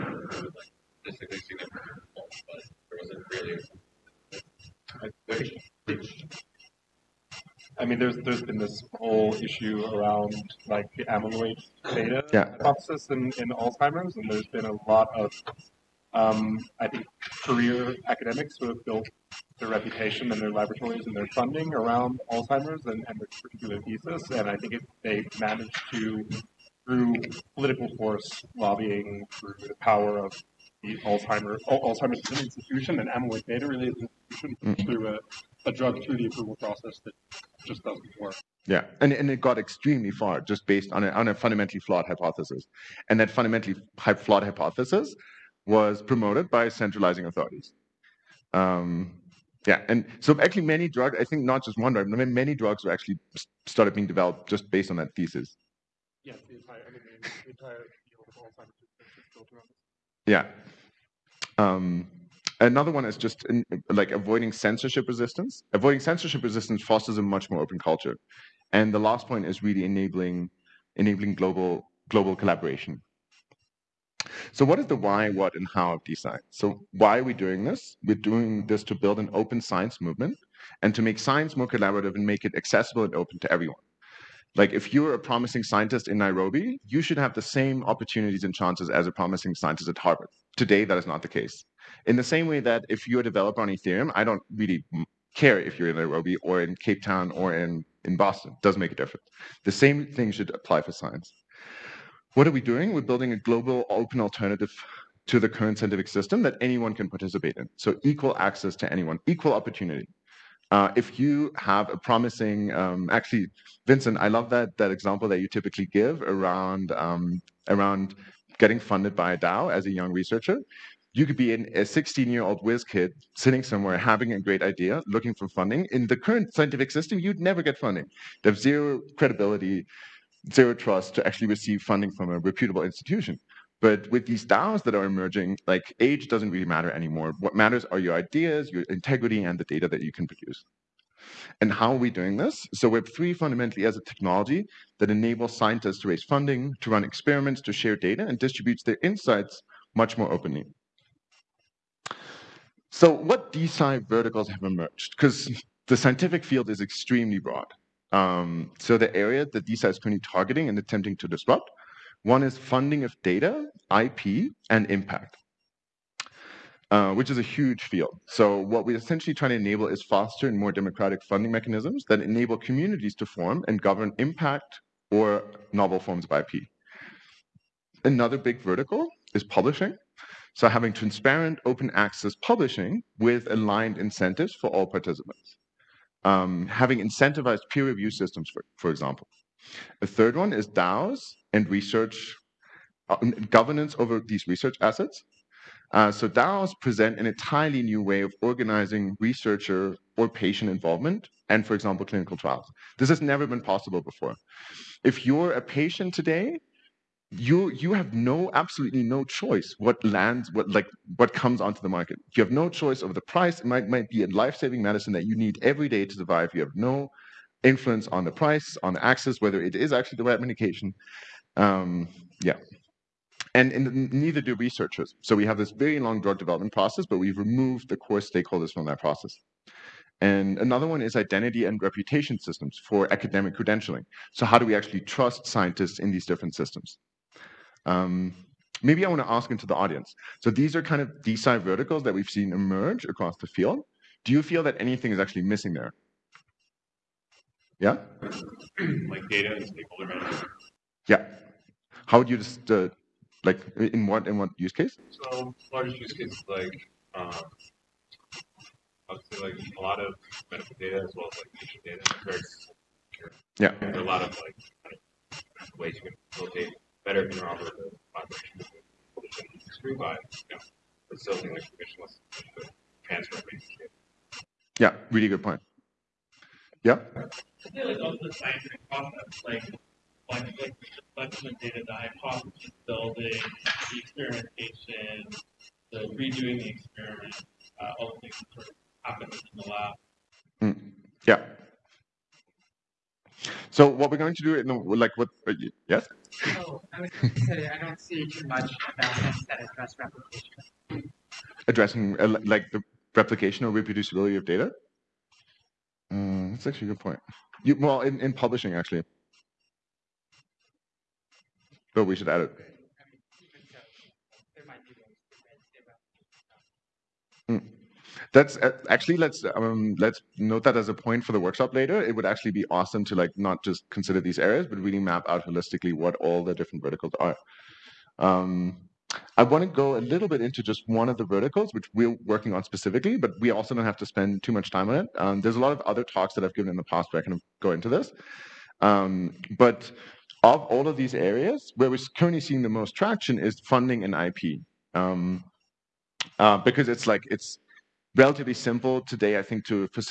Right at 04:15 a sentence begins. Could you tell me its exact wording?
So large use cases like um, obviously like a lot of medical data as well as like patient data.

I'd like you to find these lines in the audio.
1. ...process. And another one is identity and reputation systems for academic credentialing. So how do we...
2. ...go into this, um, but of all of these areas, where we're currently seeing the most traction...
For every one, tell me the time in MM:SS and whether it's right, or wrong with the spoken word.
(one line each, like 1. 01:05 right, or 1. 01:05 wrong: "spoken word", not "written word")
1. 03:48 right
2. 05:37 right.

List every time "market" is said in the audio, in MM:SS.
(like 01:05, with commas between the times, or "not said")
03:31.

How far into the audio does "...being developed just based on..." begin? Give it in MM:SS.
00:53.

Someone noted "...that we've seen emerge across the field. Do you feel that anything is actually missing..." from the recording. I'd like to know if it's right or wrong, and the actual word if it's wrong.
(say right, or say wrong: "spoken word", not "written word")
right.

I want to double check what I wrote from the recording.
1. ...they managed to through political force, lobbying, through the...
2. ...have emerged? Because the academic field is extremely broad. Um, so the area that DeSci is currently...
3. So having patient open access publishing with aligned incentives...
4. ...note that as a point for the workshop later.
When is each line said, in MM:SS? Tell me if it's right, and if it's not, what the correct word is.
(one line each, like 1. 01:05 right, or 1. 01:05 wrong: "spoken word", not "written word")
1. 00:25 right
2. 02:34 wrong: "scientific", not "academic"
3. 03:00 wrong: "transparent", not "patient"
4. 05:20 right.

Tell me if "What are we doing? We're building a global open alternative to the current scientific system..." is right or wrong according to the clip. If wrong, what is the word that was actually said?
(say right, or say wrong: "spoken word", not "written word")
right.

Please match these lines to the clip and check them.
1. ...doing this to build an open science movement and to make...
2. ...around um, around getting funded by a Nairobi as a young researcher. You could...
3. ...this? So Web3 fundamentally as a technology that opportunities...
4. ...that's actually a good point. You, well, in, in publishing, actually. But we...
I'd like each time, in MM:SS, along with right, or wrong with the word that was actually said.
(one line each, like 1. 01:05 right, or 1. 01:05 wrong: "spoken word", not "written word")
1. 01:18 right
2. 01:56 wrong: "DAO", not "Nairobi"
3. 02:22 wrong: "enables", not "opportunities"
4. 05:06 right.